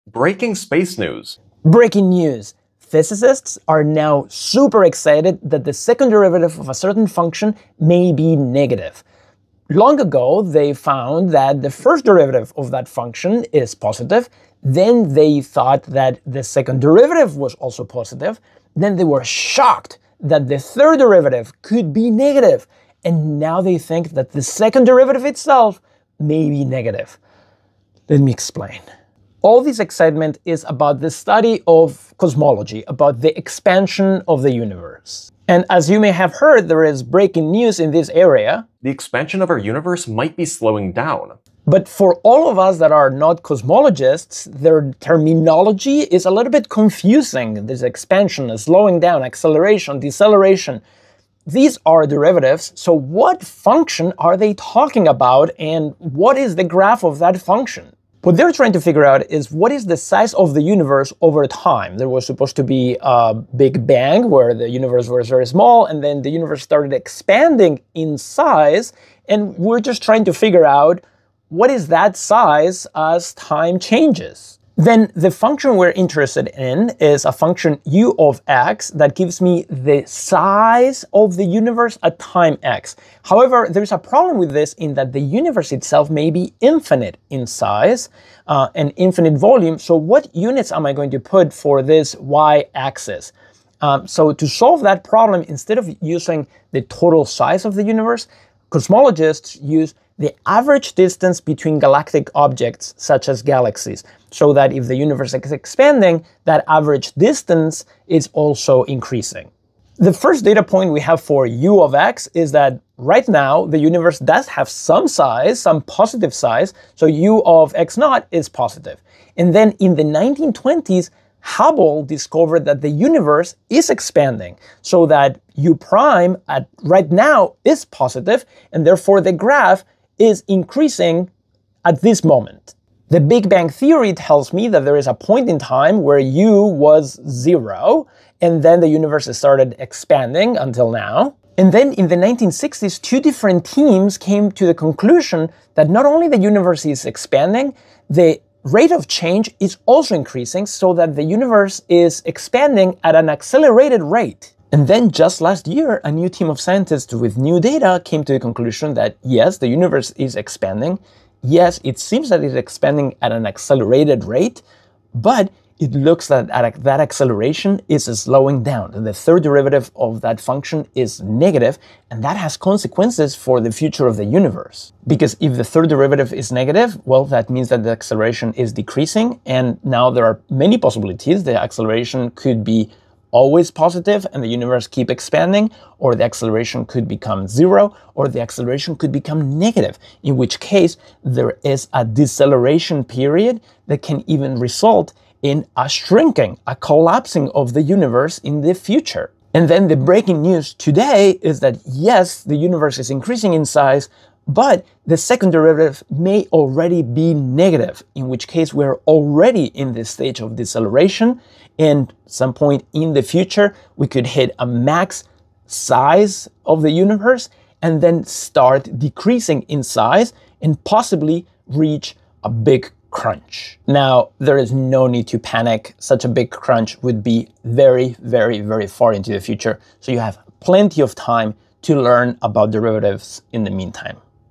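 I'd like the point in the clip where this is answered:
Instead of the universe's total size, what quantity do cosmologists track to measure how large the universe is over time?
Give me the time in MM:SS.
01:40.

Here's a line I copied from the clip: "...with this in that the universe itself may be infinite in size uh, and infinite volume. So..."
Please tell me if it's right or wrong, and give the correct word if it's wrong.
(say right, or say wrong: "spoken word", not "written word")
right.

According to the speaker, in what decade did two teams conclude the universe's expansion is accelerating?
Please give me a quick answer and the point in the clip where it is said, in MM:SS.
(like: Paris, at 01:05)
1960s, at 02:22.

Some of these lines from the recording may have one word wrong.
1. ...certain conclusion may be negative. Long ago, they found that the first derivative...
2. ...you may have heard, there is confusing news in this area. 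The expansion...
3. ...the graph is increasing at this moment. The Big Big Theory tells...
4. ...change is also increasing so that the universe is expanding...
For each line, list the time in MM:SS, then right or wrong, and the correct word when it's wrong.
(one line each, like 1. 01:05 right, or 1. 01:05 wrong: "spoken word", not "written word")
1. 00:06 wrong: "function", not "conclusion"
2. 00:35 wrong: "breaking", not "confusing"
3. 02:09 wrong: "Bang", not "Big"
4. 02:29 right.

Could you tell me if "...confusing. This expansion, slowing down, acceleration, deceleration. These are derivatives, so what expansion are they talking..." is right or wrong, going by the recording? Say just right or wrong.
wrong.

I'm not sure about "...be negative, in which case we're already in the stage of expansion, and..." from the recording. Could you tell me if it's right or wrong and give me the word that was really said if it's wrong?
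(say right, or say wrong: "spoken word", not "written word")
wrong: "deceleration", not "expansion".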